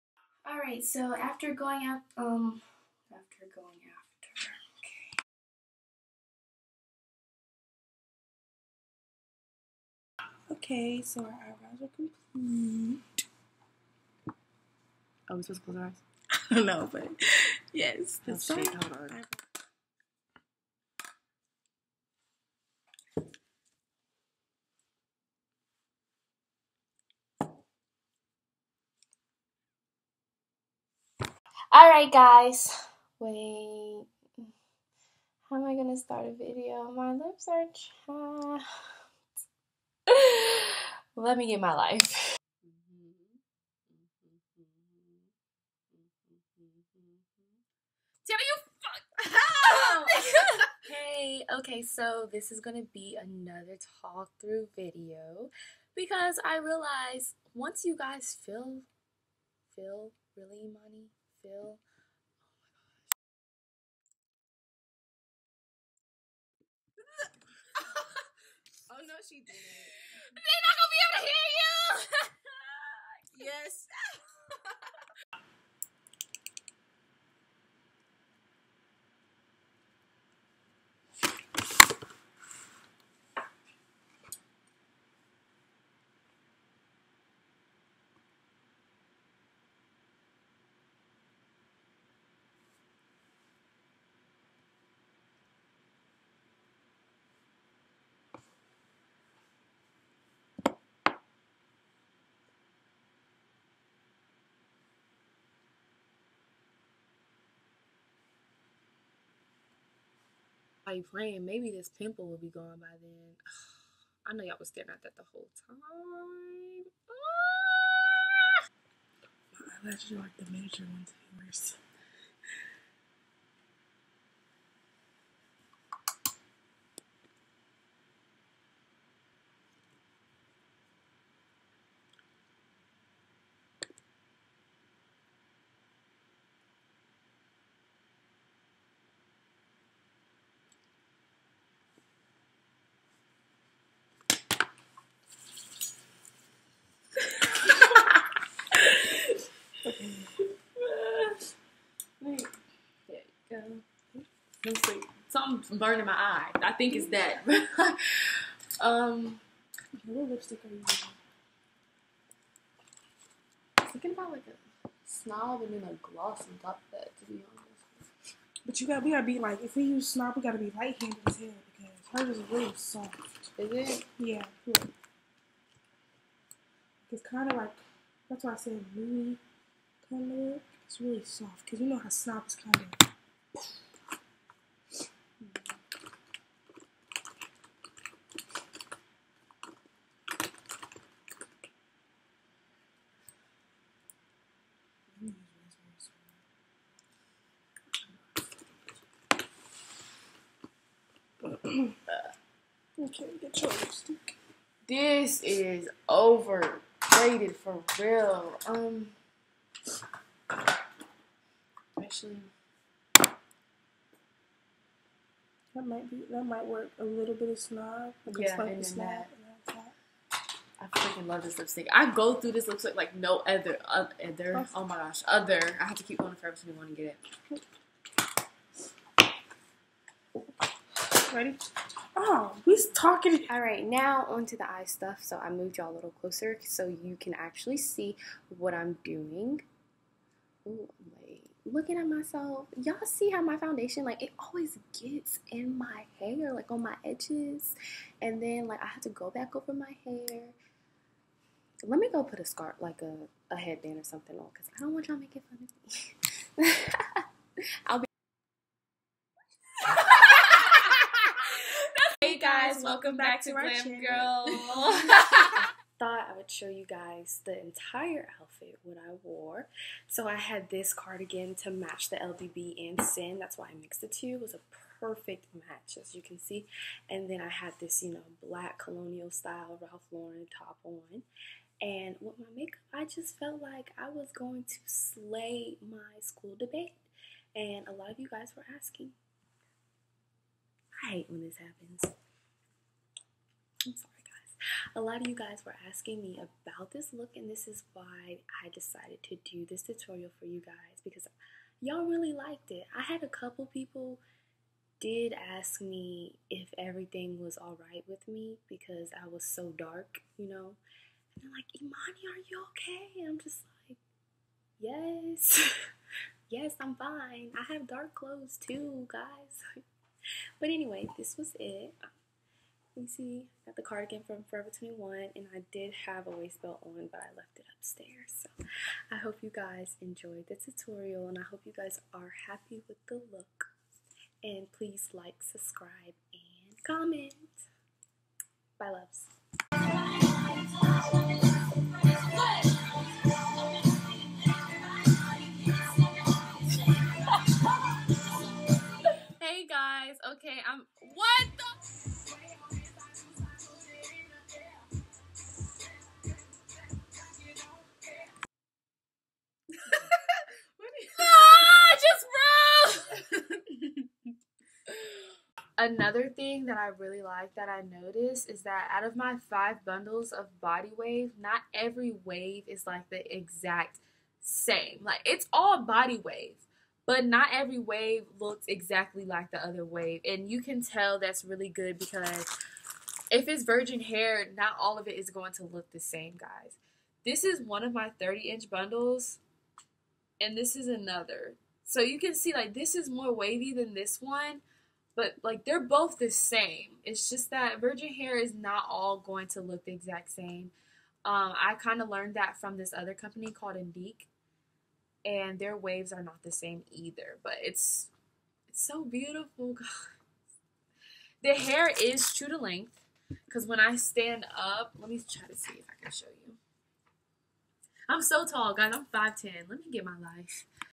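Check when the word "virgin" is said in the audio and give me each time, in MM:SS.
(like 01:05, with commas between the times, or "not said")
06:23, 06:37.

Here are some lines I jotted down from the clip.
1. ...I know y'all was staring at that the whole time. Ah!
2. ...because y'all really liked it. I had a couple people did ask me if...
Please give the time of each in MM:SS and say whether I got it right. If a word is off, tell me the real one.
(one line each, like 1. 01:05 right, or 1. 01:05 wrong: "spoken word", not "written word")
1. 01:54 right
2. 05:01 right.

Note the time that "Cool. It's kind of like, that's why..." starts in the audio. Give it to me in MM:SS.
02:54.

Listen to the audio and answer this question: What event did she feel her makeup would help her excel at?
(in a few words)
school debate.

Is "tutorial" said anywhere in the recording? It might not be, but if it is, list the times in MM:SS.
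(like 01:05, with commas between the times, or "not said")
04:59, 05:30.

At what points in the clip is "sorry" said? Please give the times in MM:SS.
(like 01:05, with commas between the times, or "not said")
04:53.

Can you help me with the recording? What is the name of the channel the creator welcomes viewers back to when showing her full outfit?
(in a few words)
Glam Girl.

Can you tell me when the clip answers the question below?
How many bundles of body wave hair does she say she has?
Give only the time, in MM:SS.
06:09.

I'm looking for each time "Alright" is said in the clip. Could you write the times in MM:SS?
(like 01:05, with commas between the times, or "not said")
00:00, 00:31.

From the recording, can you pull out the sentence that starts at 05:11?
And they're like, Imani, are you okay?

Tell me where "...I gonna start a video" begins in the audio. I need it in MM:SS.
00:35.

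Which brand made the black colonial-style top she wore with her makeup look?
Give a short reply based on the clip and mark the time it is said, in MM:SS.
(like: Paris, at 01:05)
Ralph Lauren, at 04:39.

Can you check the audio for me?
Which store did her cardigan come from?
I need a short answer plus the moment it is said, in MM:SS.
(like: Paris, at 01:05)
Forever 21, at 05:24.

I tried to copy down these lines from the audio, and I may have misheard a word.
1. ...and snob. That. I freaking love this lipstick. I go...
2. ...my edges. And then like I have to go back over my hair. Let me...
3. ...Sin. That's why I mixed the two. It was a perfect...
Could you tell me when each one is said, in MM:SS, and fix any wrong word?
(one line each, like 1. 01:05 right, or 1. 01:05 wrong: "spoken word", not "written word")
1. 03:38 right
2. 04:06 right
3. 04:33 right.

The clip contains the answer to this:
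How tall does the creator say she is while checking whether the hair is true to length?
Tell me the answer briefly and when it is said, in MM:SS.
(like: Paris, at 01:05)
5'10", at 06:59.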